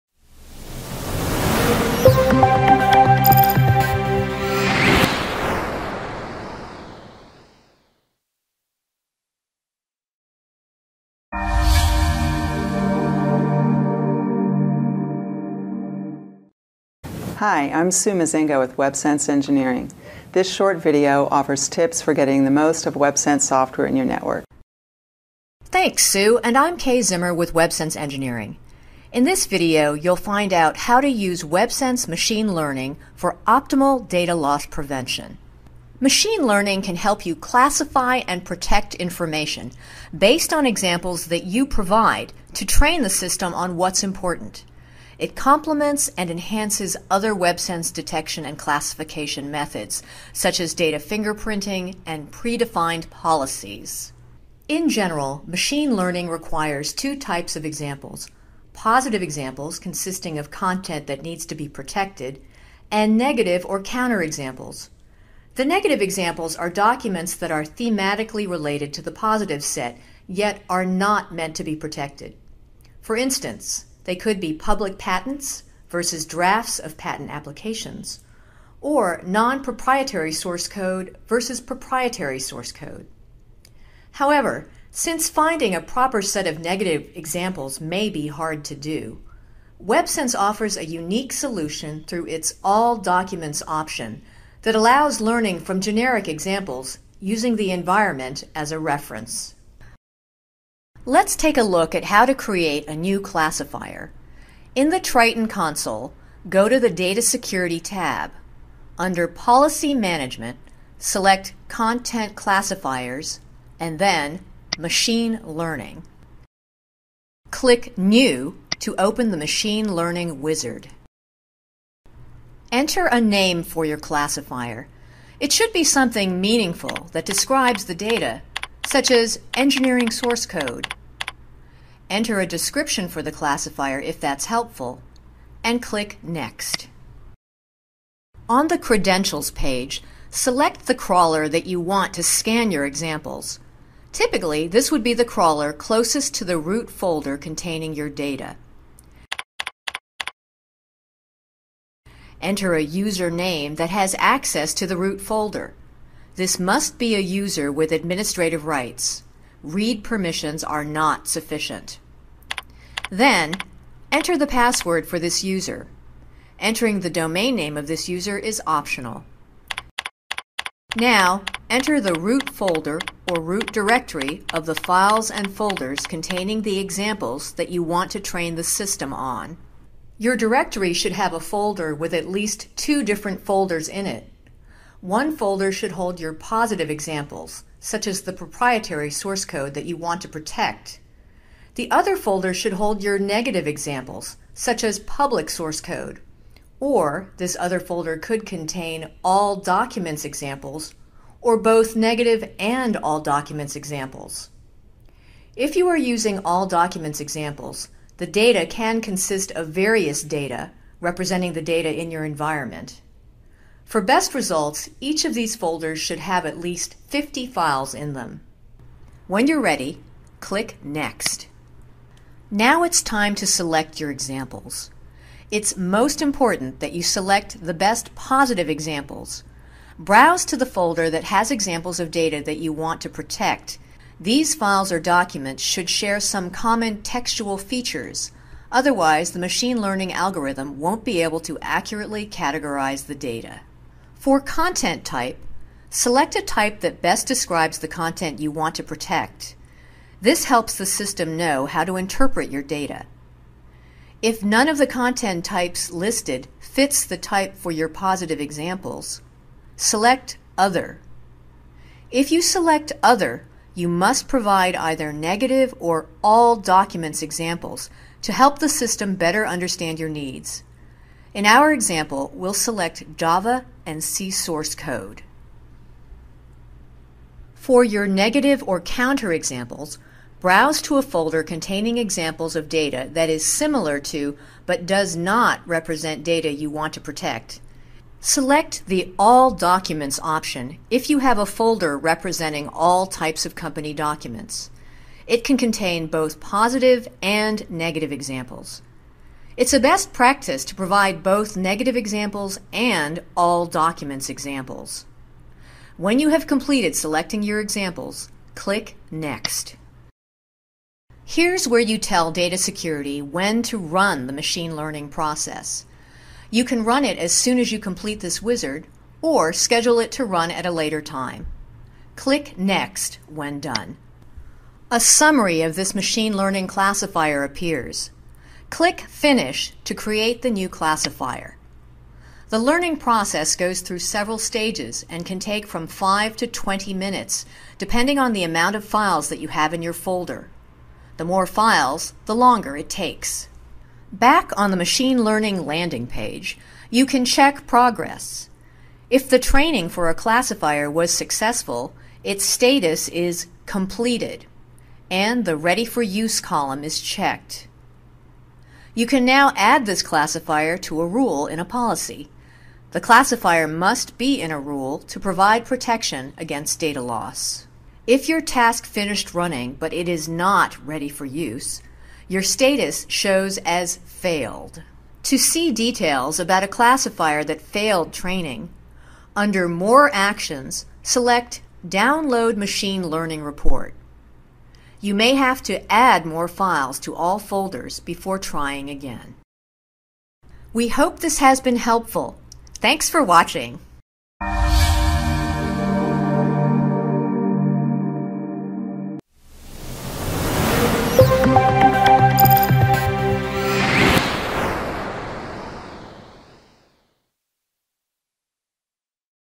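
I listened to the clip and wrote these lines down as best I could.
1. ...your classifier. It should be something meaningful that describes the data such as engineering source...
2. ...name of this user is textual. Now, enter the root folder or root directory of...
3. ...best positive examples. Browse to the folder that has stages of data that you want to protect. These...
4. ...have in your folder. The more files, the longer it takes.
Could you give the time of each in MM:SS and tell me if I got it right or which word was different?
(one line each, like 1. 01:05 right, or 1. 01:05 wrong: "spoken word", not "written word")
1. 02:03 right
2. 02:47 wrong: "optional", not "textual"
3. 03:47 wrong: "examples", not "stages"
4. 05:39 right.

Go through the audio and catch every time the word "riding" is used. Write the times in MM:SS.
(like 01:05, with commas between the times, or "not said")
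not said.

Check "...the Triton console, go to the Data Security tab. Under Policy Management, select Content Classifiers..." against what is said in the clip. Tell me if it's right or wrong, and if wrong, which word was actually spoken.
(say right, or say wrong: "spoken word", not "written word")
right.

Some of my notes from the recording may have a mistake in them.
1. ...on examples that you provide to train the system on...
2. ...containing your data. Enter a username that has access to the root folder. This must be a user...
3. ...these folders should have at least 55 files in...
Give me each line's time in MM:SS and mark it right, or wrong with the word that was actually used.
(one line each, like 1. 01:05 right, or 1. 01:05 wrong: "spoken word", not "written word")
1. 00:40 right
2. 02:27 right
3. 03:35 wrong: "50", not "55".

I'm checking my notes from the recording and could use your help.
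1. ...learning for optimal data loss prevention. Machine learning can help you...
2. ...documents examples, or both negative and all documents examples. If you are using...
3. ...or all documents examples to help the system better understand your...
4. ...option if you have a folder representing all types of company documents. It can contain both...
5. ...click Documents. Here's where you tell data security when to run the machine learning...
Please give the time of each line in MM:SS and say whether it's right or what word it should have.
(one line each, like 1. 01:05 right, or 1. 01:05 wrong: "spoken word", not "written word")
1. 00:32 right
2. 03:19 right
3. 04:25 right
4. 04:50 right
5. 05:08 wrong: "Next", not "Documents".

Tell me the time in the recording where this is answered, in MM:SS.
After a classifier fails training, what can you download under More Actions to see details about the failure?
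06:22.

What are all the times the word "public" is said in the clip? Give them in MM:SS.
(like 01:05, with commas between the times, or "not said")
01:14, 03:14.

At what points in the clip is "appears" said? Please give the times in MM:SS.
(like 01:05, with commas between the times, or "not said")
05:27.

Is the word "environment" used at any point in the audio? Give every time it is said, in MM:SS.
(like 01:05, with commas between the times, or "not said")
01:37, 03:32.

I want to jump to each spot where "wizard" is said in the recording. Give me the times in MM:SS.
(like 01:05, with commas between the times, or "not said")
02:00, 05:18.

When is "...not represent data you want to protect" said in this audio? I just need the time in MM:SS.
04:45.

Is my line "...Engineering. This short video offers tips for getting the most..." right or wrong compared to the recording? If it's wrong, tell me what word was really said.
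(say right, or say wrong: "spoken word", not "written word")
right.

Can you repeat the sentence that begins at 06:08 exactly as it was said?
If your task finished running but it is not ready for use, your status shows as failed.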